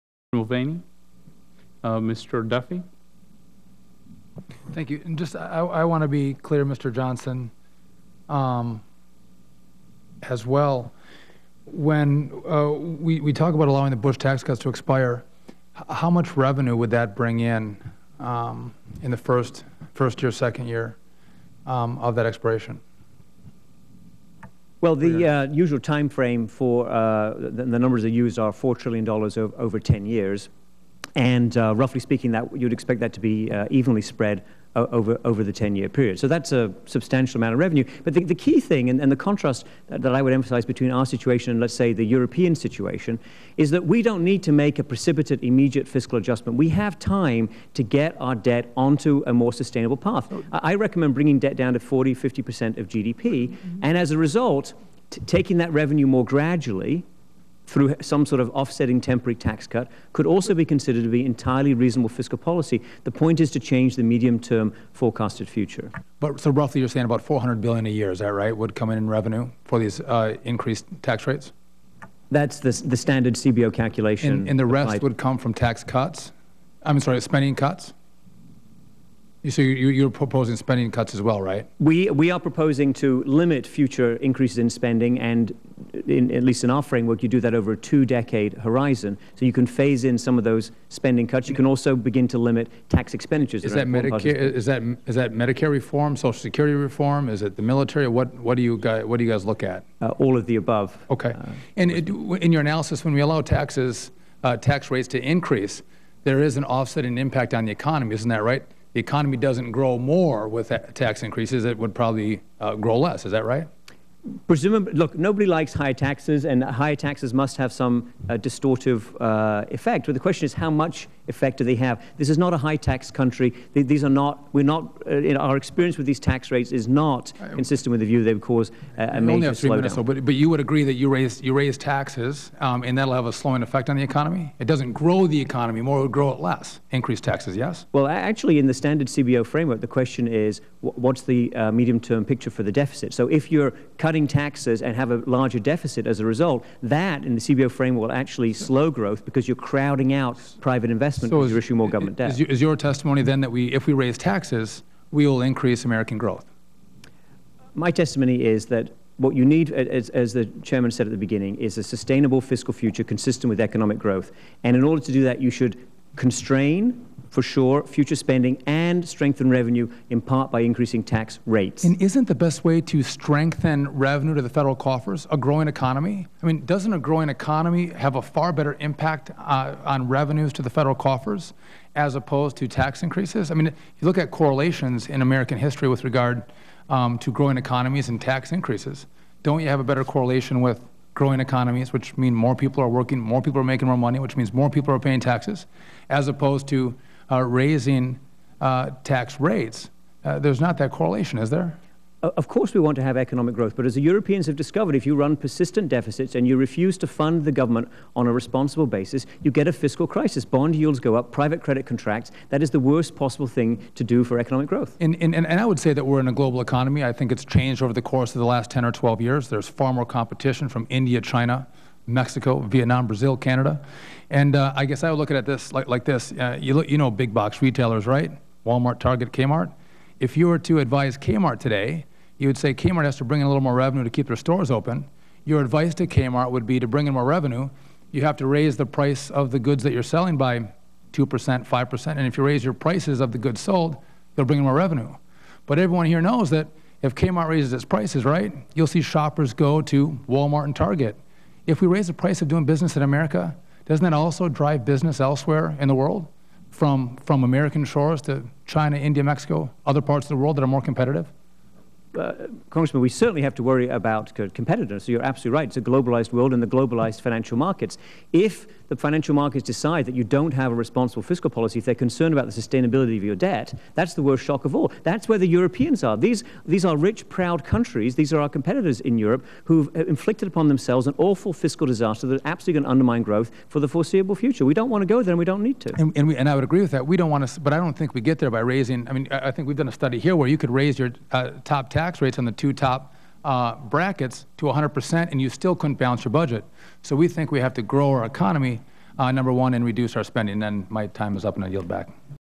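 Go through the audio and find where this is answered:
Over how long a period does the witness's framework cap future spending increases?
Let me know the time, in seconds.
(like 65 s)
87 s.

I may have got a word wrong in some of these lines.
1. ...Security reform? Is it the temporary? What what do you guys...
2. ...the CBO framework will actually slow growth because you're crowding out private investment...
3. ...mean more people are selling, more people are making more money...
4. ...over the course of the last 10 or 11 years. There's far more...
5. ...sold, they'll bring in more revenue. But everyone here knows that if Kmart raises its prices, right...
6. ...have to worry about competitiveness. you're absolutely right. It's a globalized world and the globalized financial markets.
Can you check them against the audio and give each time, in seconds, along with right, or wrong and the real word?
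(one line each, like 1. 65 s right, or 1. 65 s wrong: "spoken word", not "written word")
1. 96 s wrong: "military", not "temporary"
2. 147 s right
3. 192 s wrong: "working", not "selling"
4. 217 s wrong: "12", not "11"
5. 243 s right
6. 263 s right.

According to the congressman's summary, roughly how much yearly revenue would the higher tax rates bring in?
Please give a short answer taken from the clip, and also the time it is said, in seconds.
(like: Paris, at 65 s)
400 billion, at 67 s.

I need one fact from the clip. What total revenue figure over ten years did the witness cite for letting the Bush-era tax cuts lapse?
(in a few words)
$4 trillion.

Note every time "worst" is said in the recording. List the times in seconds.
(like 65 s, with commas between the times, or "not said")
212 s, 274 s.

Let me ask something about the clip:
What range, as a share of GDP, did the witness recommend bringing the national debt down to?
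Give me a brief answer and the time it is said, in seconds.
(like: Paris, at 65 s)
40, 50%, at 51 s.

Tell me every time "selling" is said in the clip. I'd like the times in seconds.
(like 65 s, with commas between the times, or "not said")
240 s.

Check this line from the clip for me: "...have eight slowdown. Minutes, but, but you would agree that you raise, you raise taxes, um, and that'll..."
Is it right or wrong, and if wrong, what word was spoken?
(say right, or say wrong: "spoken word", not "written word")
wrong: "three", not "eight".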